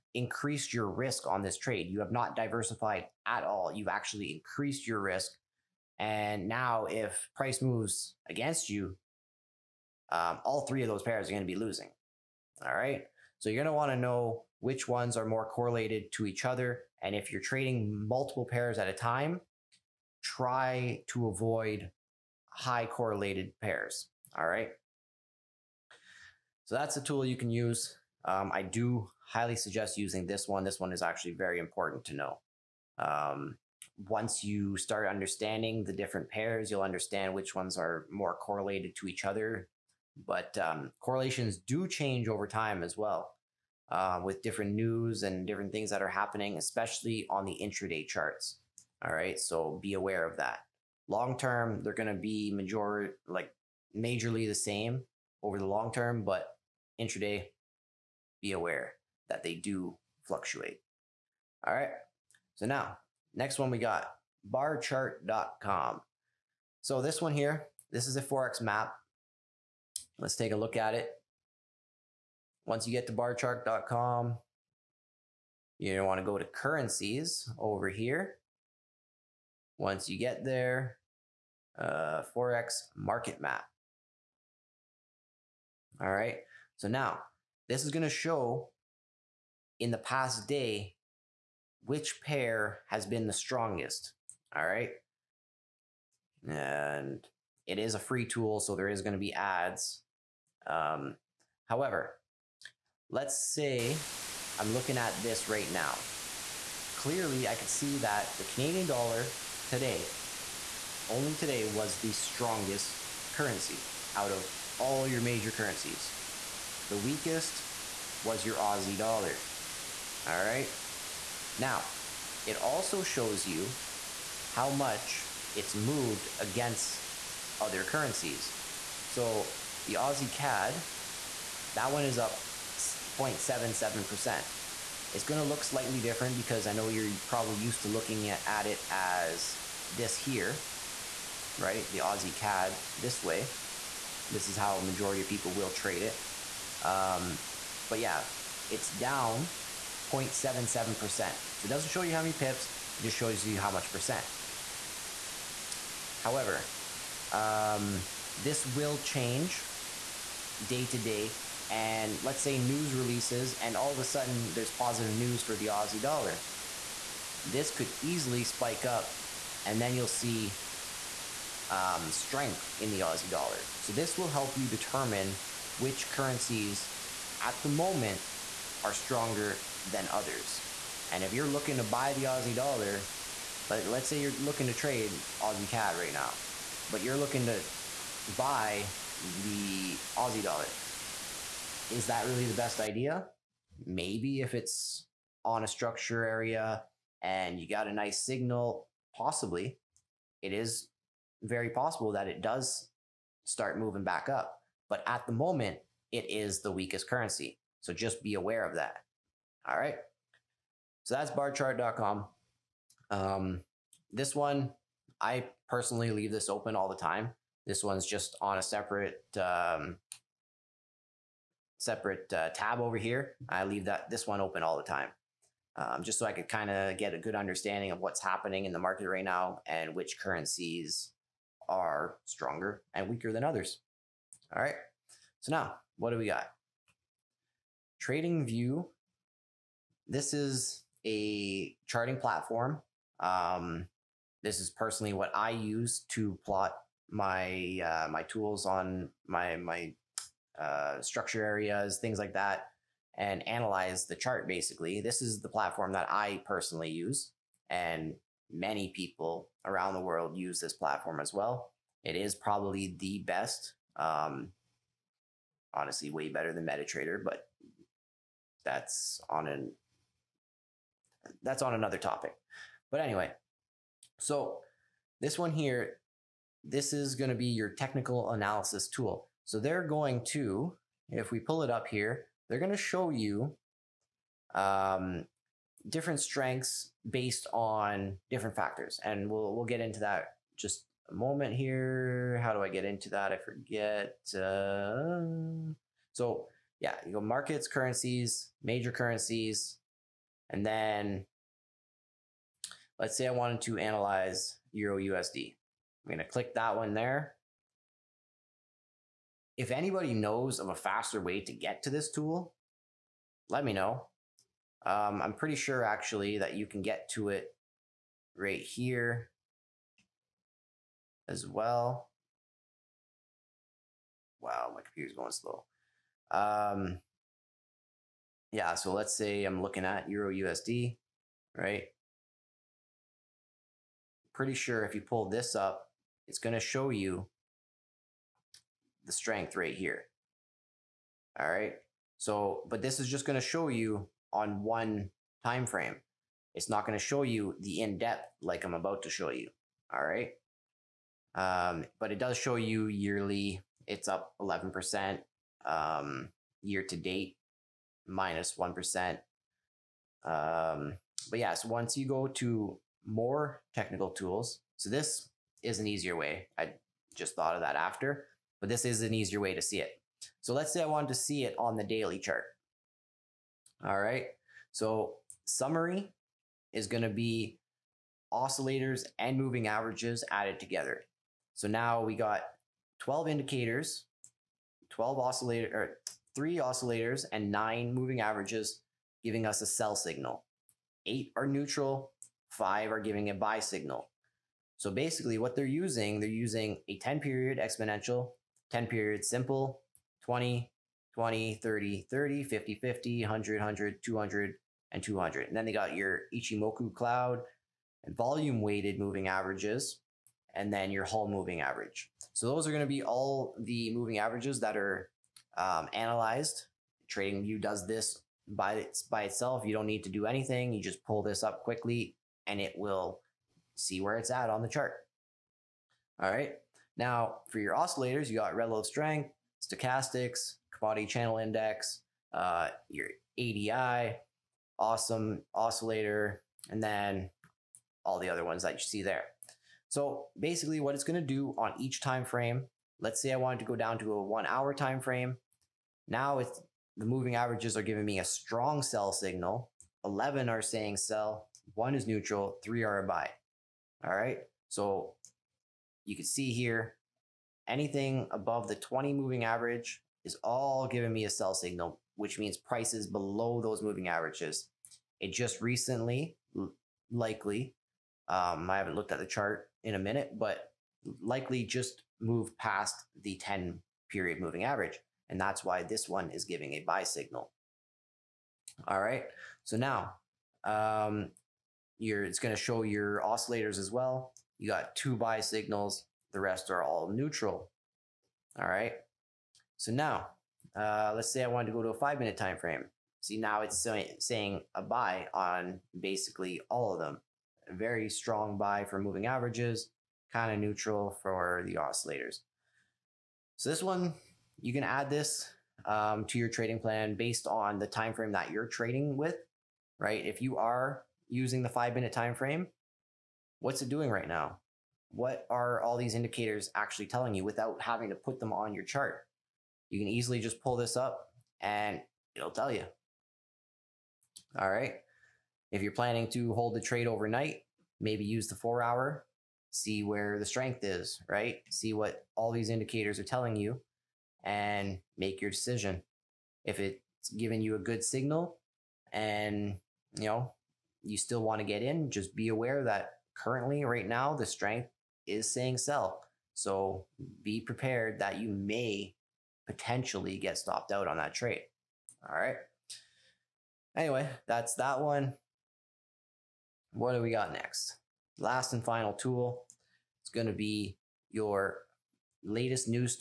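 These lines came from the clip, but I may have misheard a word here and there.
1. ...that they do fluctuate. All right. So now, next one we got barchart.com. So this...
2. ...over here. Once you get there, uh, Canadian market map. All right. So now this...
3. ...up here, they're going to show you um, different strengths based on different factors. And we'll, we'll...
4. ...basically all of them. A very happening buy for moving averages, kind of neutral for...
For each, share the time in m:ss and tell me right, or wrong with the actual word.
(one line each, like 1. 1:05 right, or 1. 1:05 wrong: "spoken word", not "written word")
1. 0:59 right
2. 1:17 wrong: "Forex", not "Canadian"
3. 4:41 right
4. 8:15 wrong: "strong", not "happening".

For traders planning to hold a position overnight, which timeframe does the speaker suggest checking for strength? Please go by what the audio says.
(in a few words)
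Four hour.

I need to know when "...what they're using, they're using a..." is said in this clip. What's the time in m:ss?
6:35.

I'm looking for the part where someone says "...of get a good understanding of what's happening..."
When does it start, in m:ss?
3:46.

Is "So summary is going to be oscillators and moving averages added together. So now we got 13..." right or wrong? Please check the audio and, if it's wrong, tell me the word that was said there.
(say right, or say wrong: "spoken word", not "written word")
wrong: "12", not "13".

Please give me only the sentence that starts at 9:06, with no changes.
So be prepared that you may potentially get stopped out on that trade.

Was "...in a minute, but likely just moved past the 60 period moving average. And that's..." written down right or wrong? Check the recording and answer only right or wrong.
wrong.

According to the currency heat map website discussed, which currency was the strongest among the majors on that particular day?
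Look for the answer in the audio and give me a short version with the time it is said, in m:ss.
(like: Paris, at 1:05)
Canadian dollar, at 1:48.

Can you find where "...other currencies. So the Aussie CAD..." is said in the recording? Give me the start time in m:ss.
2:07.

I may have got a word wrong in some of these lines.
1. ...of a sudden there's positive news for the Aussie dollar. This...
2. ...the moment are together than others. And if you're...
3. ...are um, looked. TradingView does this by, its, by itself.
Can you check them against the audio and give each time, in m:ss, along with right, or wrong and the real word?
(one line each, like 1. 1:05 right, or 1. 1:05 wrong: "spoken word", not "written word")
1. 2:43 right
2. 2:57 wrong: "stronger", not "together"
3. 6:54 wrong: "analyzed", not "looked".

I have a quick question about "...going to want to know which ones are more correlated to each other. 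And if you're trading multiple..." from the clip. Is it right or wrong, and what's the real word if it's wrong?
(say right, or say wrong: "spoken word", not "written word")
right.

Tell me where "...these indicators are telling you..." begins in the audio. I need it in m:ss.
8:52.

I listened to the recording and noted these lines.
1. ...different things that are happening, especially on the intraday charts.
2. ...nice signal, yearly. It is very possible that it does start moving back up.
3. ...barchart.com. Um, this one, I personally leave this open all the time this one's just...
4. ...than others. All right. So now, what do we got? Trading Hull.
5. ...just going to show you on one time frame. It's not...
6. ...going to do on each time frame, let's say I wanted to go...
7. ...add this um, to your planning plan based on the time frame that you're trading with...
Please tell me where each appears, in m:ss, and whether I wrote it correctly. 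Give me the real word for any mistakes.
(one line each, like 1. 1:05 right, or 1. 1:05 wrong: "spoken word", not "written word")
1. 0:45 right
2. 3:17 wrong: "possibly", not "yearly"
3. 3:31 right
4. 3:53 wrong: "View", not "Hull"
5. 5:43 right
6. 7:21 right
7. 8:24 wrong: "trading", not "planning".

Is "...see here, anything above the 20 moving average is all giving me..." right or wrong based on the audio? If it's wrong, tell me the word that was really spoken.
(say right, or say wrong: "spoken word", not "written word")
right.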